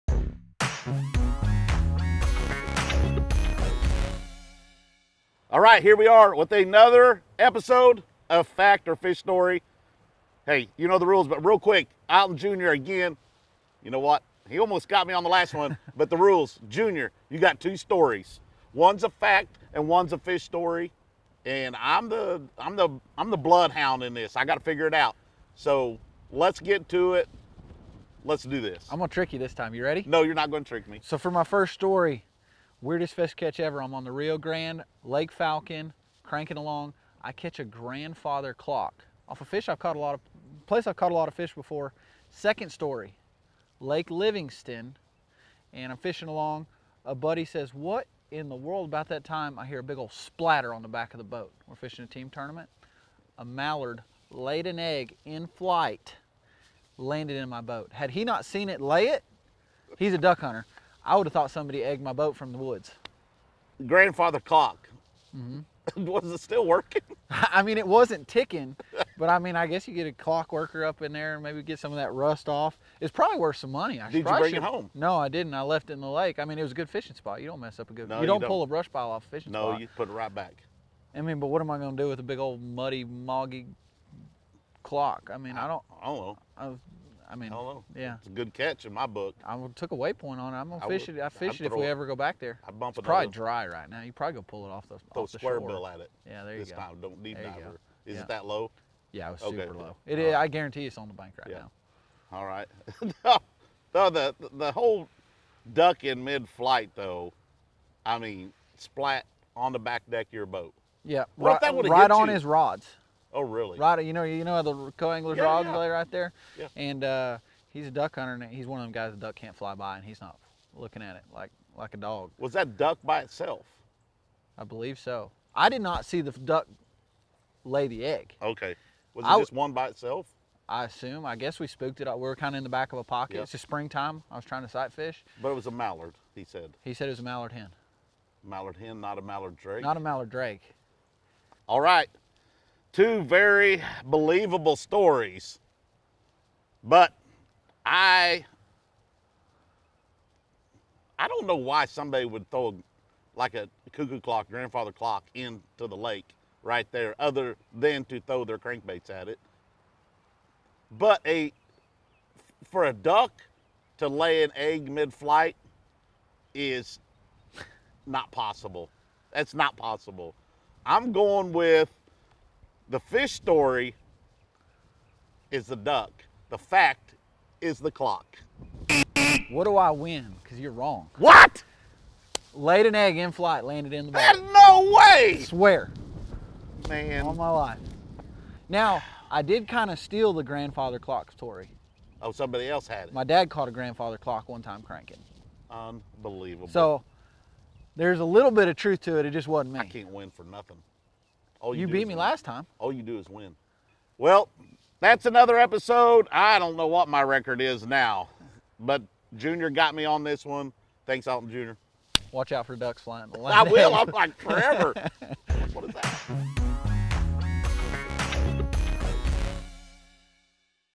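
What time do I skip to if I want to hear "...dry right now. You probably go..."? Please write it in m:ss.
1:33.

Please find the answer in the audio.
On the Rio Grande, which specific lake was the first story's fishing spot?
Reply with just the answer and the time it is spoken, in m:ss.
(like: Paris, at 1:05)
Lake Falcon, at 0:35.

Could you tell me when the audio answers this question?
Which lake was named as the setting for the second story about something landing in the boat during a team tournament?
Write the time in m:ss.
0:43.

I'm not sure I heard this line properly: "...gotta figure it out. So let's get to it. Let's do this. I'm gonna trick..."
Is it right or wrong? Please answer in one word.
right.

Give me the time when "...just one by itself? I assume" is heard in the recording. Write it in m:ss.
2:09.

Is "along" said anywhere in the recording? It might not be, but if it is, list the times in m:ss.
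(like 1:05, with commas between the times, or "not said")
0:36, 0:46.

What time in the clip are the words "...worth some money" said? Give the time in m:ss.
1:13.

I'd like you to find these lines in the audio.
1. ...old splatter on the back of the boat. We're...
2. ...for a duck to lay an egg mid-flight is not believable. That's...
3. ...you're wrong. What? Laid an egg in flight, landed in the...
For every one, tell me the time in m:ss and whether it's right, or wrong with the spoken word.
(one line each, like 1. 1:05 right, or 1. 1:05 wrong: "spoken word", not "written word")
1. 0:49 right
2. 2:42 wrong: "possible", not "believable"
3. 3:00 right.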